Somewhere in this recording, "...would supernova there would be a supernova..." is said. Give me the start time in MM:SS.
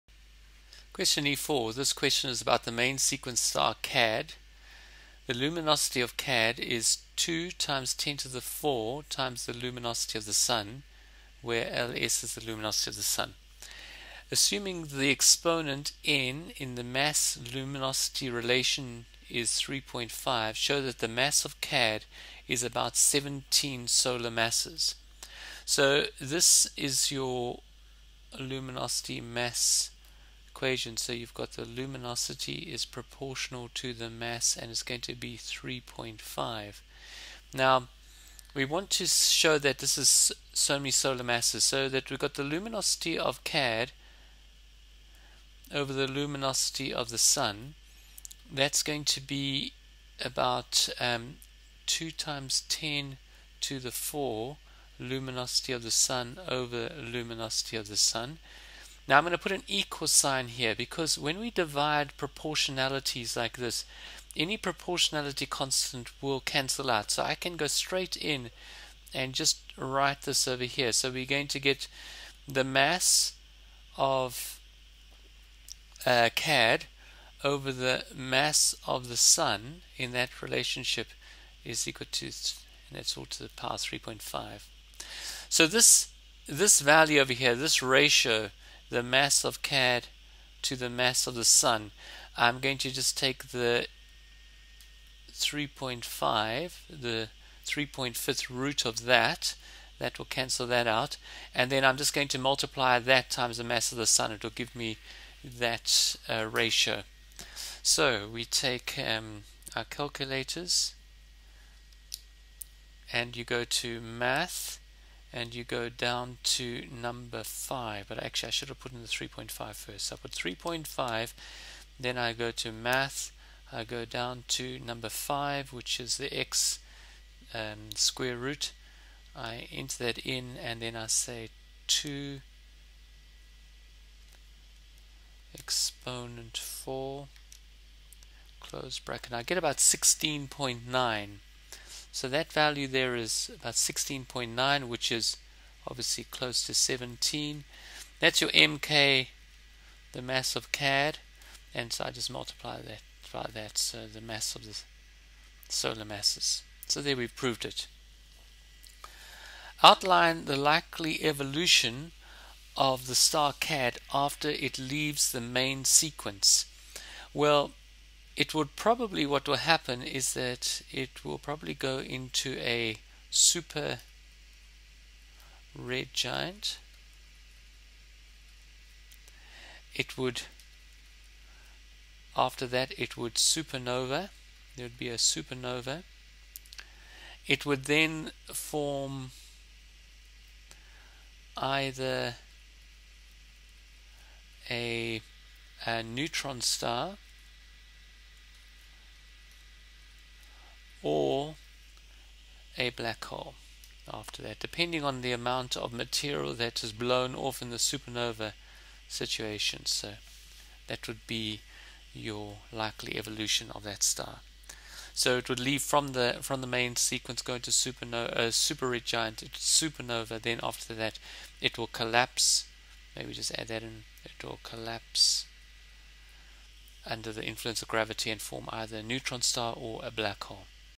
03:03.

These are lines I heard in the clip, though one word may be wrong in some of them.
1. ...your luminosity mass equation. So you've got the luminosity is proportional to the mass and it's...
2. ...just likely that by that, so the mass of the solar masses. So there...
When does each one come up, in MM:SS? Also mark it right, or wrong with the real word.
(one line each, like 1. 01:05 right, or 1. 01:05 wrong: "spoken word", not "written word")
1. 00:27 right
2. 02:32 wrong: "multiply", not "likely".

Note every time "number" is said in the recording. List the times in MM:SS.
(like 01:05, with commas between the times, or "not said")
01:56, 02:04.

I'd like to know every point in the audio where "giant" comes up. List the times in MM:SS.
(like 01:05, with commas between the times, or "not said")
02:56, 03:39.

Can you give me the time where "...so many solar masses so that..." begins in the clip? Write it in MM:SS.
00:40.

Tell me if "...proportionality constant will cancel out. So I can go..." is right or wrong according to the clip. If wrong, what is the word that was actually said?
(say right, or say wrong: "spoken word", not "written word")
right.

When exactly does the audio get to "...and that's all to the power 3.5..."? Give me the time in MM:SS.
01:22.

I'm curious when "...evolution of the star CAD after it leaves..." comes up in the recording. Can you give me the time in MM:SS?
02:41.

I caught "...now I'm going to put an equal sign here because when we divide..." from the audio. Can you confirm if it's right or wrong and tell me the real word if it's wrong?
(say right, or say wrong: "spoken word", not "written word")
right.